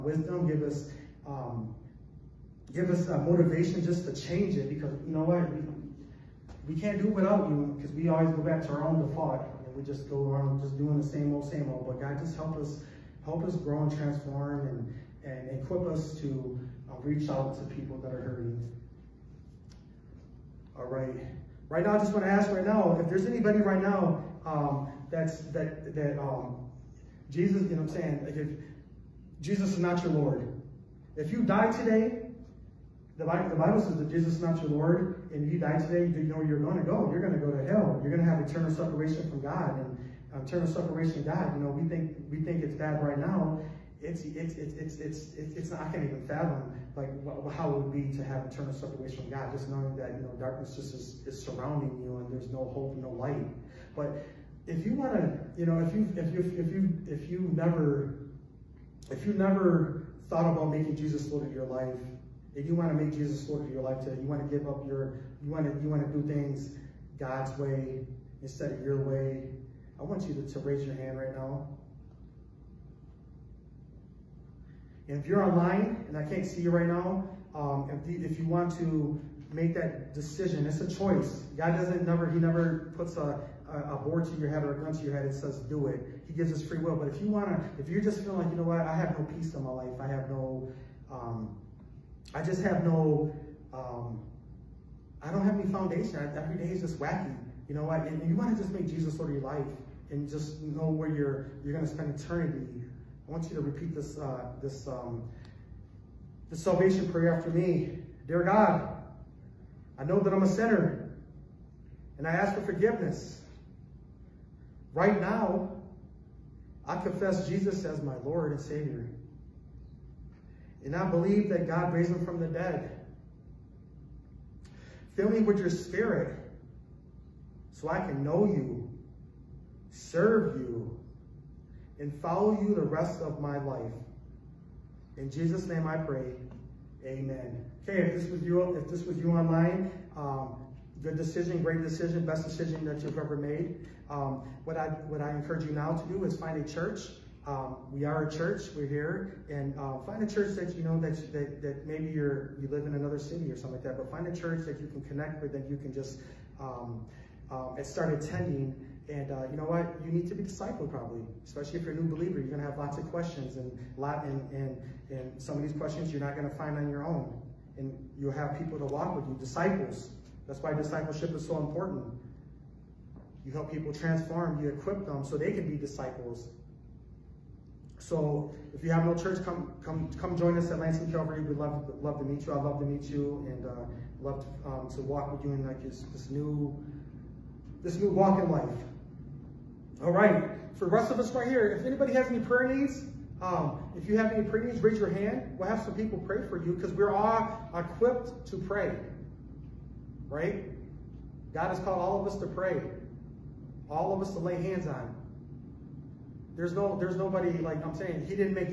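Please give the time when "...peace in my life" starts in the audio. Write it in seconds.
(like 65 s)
89 s.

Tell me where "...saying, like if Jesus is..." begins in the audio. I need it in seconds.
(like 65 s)
27 s.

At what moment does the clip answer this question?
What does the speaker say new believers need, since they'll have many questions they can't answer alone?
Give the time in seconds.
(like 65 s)
160 s.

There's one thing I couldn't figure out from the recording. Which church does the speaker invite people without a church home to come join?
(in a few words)
Lansing Calvary.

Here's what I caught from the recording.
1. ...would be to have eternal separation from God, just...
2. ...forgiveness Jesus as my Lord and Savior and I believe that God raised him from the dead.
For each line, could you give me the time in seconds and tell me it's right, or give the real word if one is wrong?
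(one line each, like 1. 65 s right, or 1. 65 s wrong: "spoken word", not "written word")
1. 47 s right
2. 116 s wrong: "confess", not "forgiveness".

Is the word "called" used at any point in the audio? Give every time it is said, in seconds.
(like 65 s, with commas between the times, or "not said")
201 s.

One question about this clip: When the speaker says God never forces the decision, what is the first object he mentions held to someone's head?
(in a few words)
a board.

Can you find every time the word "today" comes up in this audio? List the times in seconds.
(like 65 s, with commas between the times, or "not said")
31 s, 35 s, 64 s.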